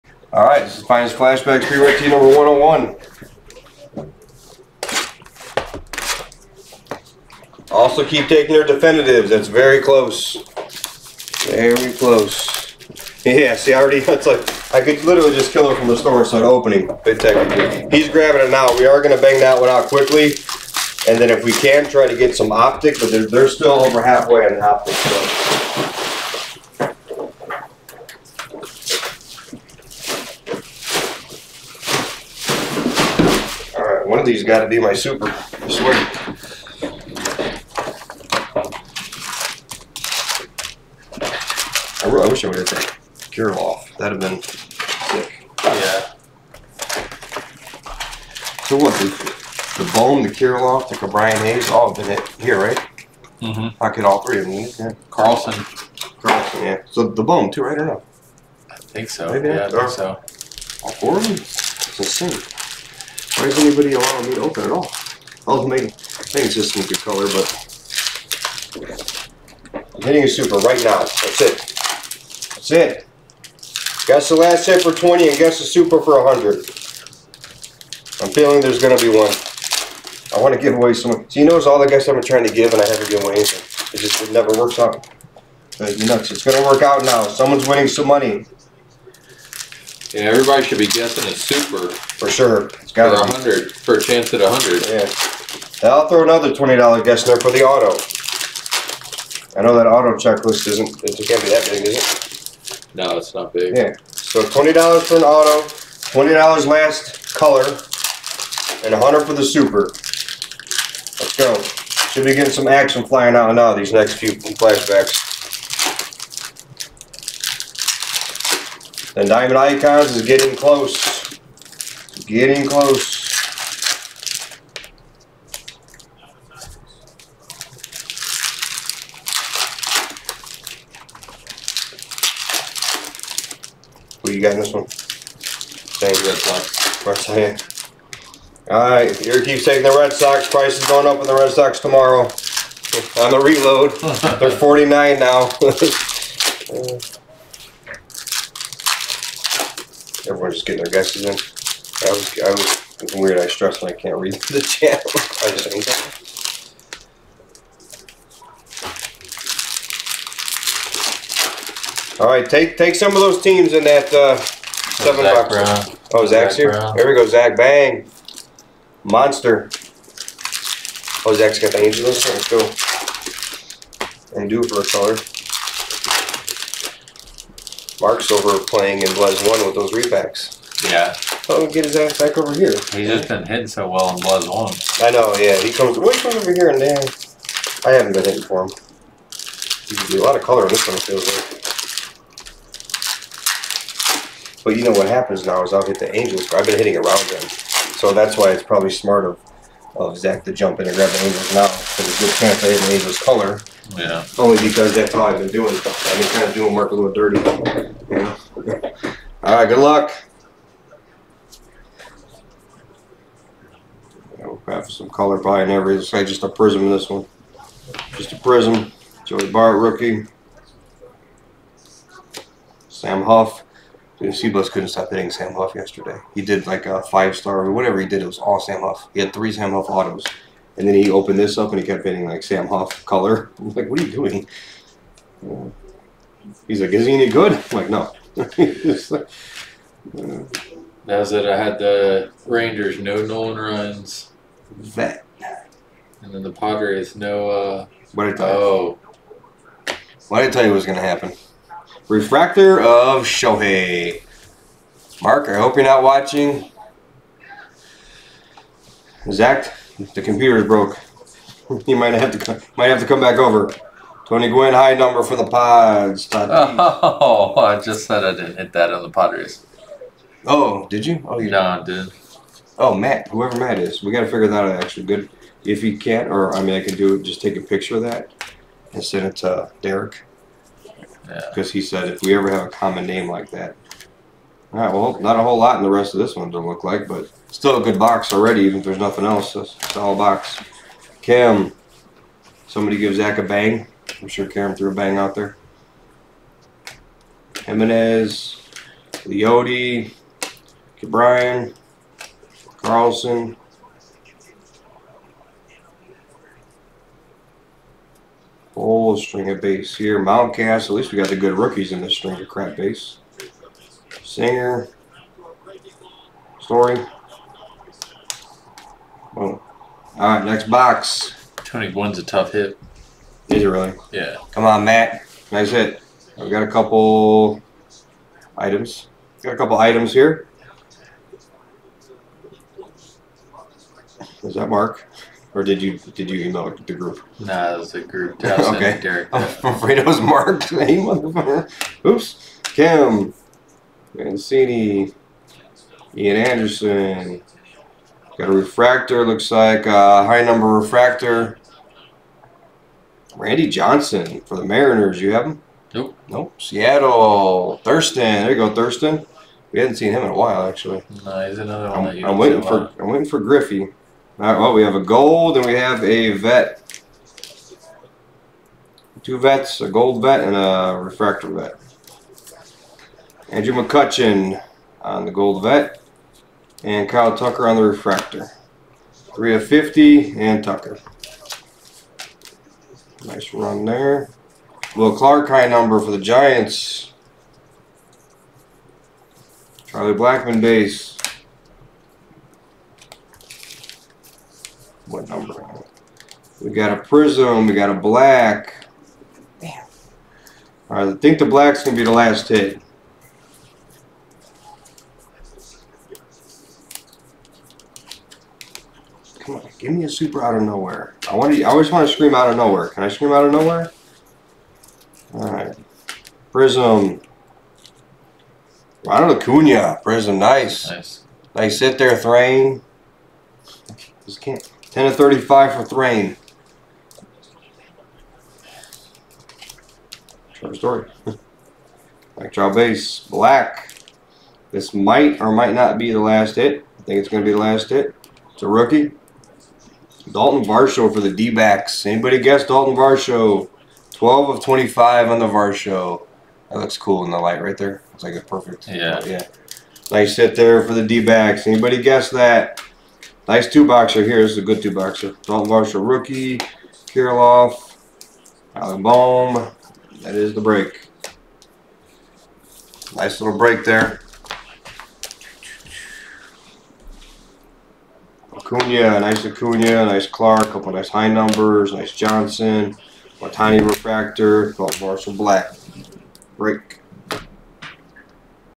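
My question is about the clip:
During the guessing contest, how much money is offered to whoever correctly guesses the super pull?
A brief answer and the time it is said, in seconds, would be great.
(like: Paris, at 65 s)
$100, at 75 s.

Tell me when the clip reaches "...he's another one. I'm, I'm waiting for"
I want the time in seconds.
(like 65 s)
361 s.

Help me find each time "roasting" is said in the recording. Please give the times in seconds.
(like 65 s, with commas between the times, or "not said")
not said.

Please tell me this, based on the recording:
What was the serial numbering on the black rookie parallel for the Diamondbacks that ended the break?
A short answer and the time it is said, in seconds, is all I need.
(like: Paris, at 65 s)
12 of 25, at 444 s.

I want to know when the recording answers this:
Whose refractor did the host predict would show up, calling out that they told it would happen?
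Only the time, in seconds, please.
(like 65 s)
252 s.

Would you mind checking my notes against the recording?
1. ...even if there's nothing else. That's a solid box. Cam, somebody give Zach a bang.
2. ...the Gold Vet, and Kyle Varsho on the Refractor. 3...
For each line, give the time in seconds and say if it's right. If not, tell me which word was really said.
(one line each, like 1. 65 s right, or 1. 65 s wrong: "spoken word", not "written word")
1. 288 s right
2. 375 s wrong: "Tucker", not "Varsho".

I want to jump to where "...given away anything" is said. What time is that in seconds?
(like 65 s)
83 s.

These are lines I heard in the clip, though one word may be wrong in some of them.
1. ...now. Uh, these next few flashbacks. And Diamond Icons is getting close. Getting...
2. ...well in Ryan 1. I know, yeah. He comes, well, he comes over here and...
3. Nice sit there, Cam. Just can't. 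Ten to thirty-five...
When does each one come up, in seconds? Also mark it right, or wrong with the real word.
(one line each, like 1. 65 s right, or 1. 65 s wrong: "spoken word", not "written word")
1. 113 s right
2. 183 s wrong: "Blez", not "Ryan"
3. 421 s wrong: "Thrain", not "Cam".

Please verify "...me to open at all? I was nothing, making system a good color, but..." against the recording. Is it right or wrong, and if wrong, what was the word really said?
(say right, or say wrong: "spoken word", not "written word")
wrong: "making", not "nothing".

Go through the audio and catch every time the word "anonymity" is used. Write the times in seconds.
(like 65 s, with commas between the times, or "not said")
not said.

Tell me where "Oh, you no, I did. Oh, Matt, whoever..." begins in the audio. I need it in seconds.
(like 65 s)
271 s.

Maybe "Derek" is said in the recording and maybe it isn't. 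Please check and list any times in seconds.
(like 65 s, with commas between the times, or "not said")
279 s, 339 s.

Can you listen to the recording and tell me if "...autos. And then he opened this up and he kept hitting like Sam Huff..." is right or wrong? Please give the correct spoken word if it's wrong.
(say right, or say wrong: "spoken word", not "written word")
right.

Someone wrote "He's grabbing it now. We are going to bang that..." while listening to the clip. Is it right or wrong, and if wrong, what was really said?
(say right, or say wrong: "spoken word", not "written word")
right.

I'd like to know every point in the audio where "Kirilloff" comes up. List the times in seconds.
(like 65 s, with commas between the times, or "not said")
50 s, 457 s.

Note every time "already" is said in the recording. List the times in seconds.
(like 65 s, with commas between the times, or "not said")
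13 s, 288 s.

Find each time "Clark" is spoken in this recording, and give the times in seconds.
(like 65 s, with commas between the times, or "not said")
385 s, 470 s.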